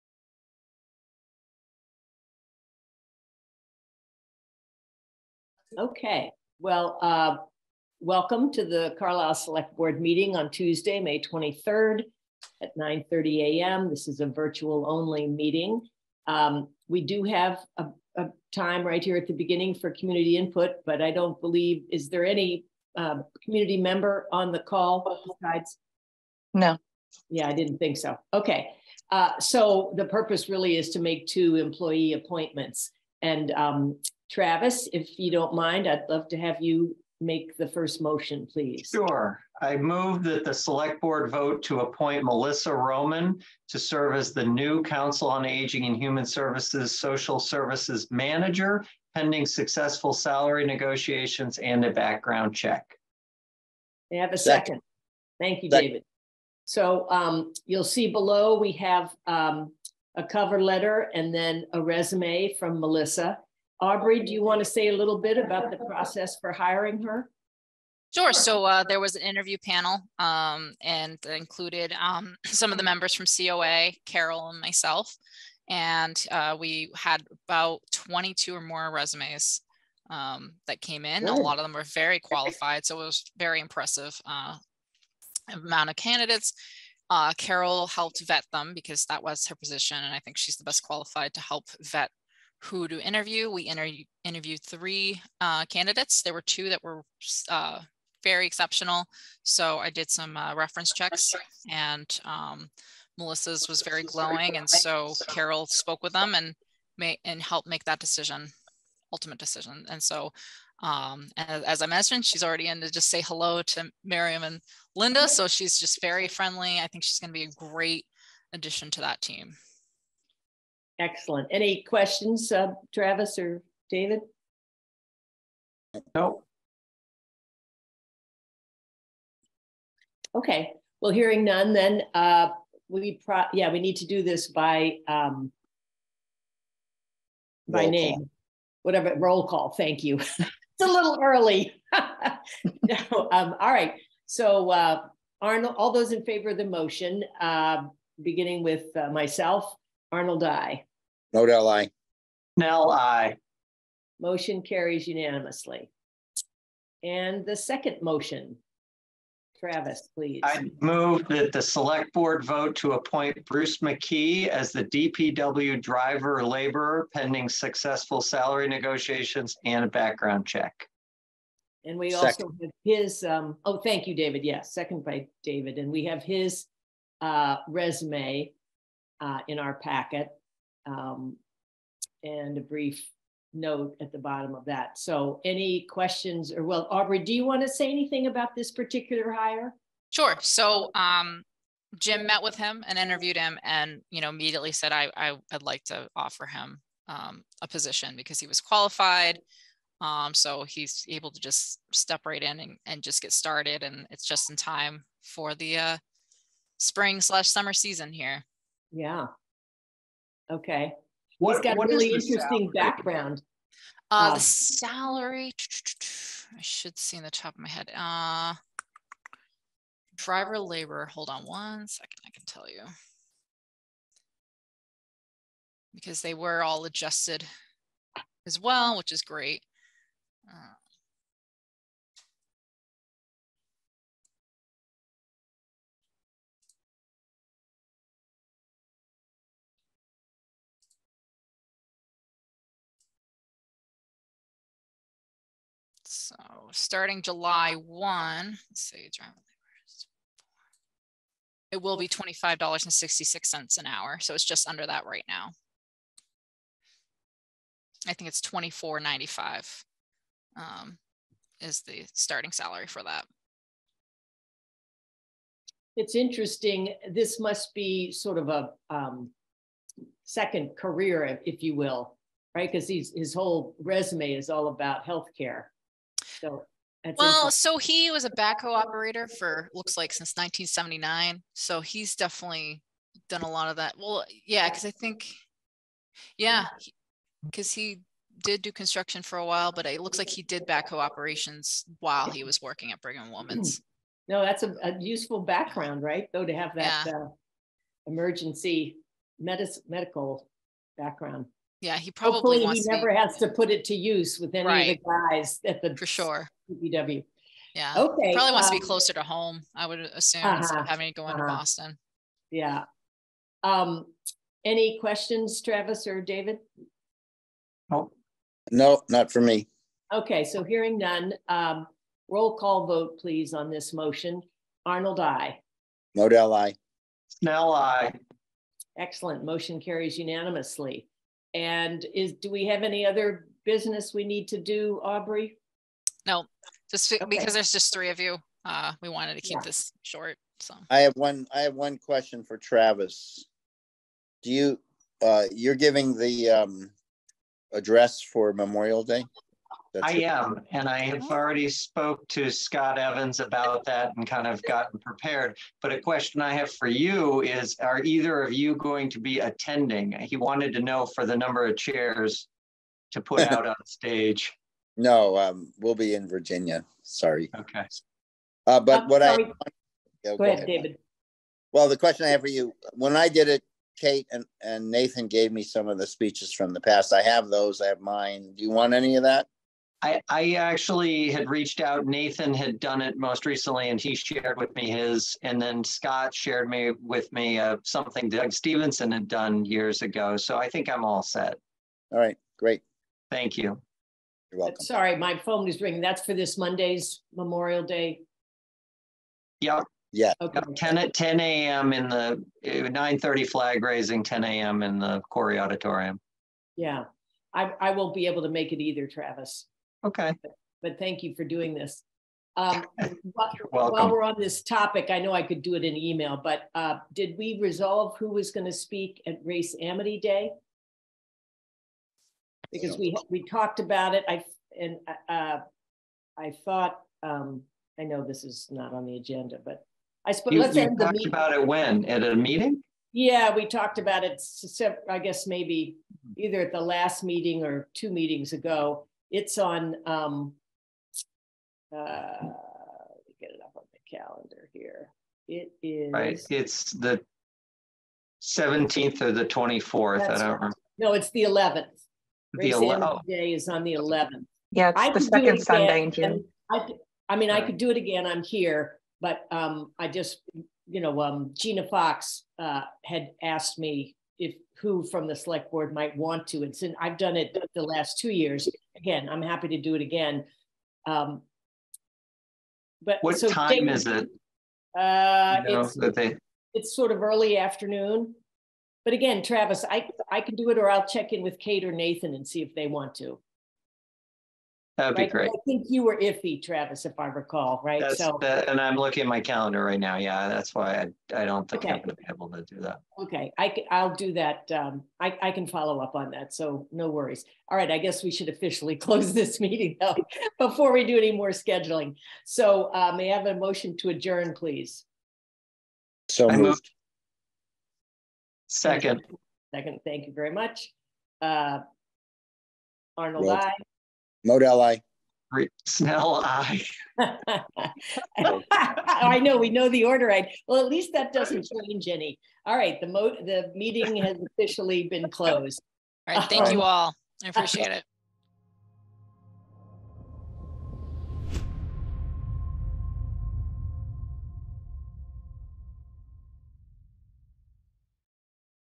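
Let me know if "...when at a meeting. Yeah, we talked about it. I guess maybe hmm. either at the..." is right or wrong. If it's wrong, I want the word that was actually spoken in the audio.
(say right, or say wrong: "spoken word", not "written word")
right.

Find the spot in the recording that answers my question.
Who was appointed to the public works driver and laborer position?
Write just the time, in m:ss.
2:43.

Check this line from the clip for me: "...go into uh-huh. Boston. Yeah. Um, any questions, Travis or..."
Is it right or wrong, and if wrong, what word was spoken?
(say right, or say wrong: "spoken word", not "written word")
right.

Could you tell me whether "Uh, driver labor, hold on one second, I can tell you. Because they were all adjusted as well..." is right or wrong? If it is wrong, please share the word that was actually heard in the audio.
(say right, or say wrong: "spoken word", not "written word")
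right.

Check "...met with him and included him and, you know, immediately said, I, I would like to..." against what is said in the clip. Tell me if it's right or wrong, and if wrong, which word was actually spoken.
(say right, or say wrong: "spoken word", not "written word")
wrong: "interviewed", not "included".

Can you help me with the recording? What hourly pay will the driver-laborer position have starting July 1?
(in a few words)
$25.66.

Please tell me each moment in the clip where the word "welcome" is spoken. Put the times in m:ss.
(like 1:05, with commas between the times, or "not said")
0:08, 6:34.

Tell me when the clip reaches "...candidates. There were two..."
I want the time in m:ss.
1:35.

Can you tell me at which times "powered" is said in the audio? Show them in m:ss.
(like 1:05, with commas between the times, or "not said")
not said.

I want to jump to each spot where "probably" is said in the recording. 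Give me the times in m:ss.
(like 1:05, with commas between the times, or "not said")
5:02, 5:08.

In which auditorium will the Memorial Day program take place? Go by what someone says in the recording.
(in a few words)
Corey Auditorium.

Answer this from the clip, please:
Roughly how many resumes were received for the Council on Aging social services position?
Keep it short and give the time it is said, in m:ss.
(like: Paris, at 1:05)
22, at 1:17.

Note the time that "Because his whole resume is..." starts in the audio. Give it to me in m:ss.
4:32.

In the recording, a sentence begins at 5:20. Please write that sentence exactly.
Okay, so hearing none, um, roll call vote, please, on this motion.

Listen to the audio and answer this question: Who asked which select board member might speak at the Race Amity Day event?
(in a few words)
Gina Fox.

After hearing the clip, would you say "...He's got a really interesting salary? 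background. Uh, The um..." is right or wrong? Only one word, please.
right.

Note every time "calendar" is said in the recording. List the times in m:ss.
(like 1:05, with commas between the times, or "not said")
7:24, 8:09.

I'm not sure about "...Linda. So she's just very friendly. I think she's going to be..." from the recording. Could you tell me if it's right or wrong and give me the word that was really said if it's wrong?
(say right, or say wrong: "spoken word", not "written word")
right.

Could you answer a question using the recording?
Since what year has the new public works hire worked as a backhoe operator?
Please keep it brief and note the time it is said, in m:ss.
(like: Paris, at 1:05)
1979, at 4:40.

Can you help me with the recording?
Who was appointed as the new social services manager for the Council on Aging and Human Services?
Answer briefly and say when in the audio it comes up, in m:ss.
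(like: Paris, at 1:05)
Melissa Roman, at 0:42.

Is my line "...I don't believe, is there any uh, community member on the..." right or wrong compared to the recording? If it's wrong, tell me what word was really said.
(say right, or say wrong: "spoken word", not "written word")
right.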